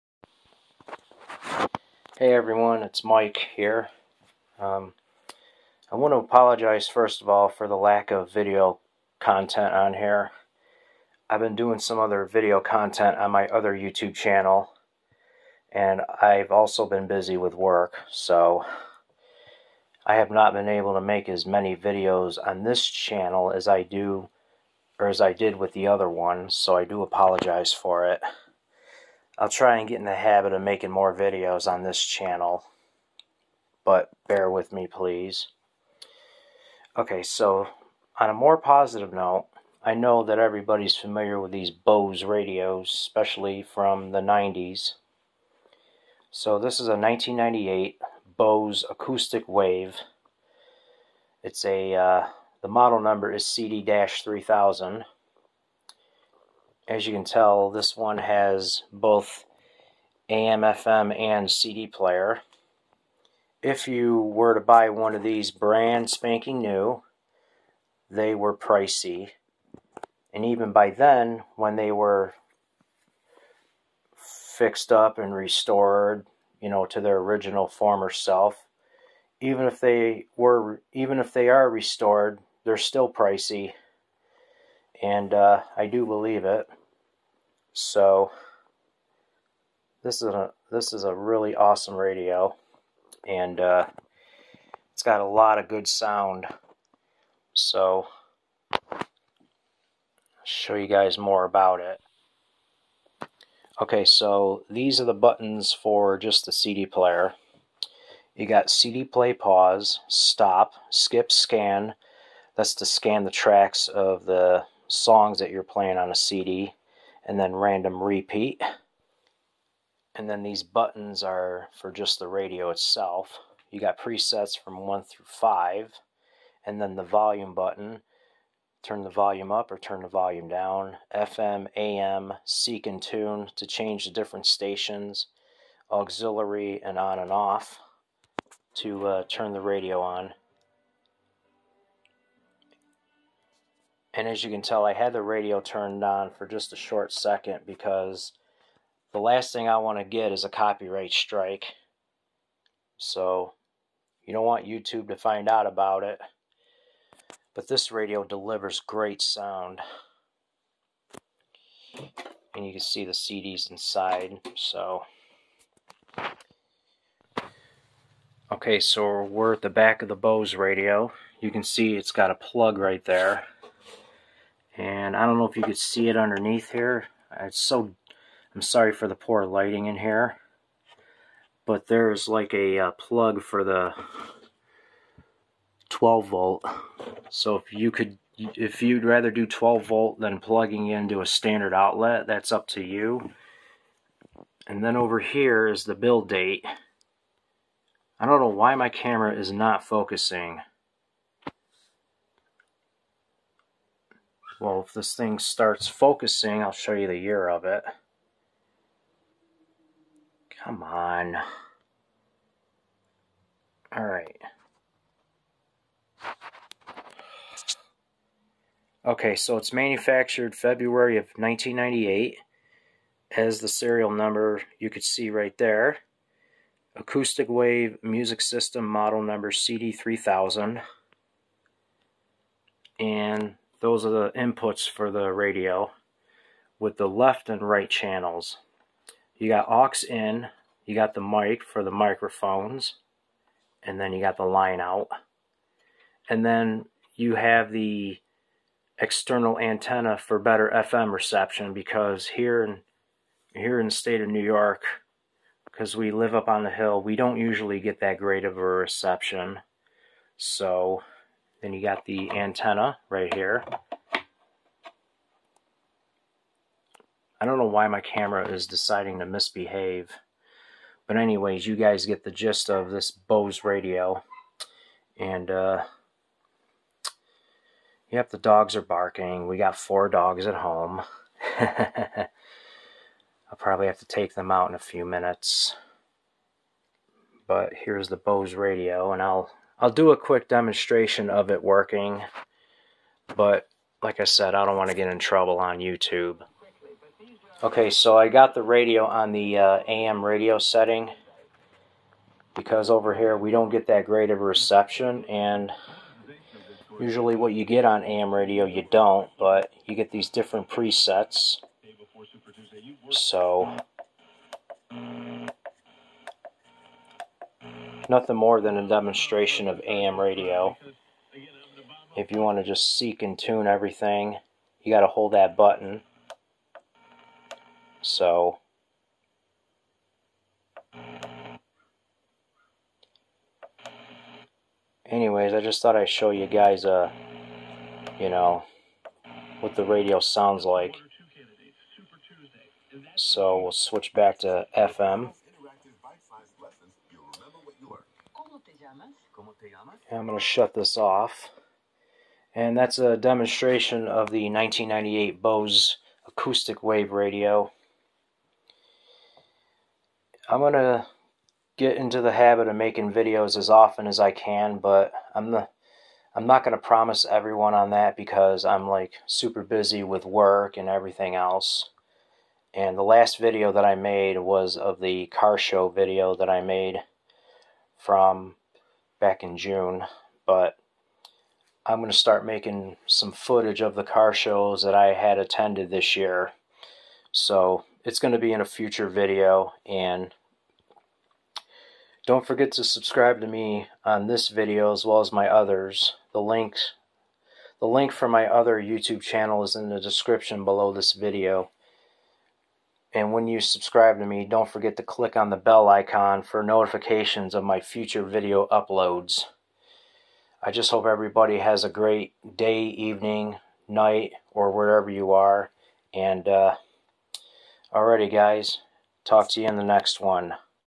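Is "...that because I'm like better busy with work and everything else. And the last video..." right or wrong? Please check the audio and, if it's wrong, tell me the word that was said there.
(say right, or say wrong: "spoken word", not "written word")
wrong: "super", not "better".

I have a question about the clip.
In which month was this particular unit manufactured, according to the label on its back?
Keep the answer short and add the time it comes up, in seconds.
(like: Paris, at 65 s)
February, at 220 s.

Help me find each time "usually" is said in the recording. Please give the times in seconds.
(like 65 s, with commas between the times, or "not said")
257 s, 306 s.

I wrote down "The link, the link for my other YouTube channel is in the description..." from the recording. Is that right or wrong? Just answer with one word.
right.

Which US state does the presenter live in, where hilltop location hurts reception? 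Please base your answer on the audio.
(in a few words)
New York.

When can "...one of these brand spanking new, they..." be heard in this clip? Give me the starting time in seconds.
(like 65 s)
64 s.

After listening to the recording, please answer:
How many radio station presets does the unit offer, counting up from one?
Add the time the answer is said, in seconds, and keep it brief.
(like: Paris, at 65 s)
5, at 125 s.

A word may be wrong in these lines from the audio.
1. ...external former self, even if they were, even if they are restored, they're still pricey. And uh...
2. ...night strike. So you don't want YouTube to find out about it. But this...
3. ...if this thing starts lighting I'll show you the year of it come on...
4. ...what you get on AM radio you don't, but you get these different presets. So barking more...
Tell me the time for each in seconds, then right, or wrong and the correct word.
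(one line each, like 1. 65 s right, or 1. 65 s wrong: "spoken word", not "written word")
1. 77 s wrong: "original", not "external"
2. 150 s wrong: "copyright", not "night"
3. 204 s wrong: "focusing", not "lighting"
4. 307 s wrong: "nothing", not "barking".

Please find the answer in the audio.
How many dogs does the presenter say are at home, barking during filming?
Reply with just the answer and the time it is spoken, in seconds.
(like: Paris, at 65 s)
4, at 279 s.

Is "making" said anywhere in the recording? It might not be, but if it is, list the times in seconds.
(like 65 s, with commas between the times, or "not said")
30 s, 362 s, 382 s.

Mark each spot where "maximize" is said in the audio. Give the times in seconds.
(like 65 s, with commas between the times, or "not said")
not said.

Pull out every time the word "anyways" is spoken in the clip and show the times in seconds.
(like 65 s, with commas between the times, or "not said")
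271 s, 335 s.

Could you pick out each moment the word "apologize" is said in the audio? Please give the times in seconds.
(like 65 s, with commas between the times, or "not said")
6 s, 27 s.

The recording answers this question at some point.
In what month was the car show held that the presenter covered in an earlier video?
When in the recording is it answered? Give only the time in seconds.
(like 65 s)
379 s.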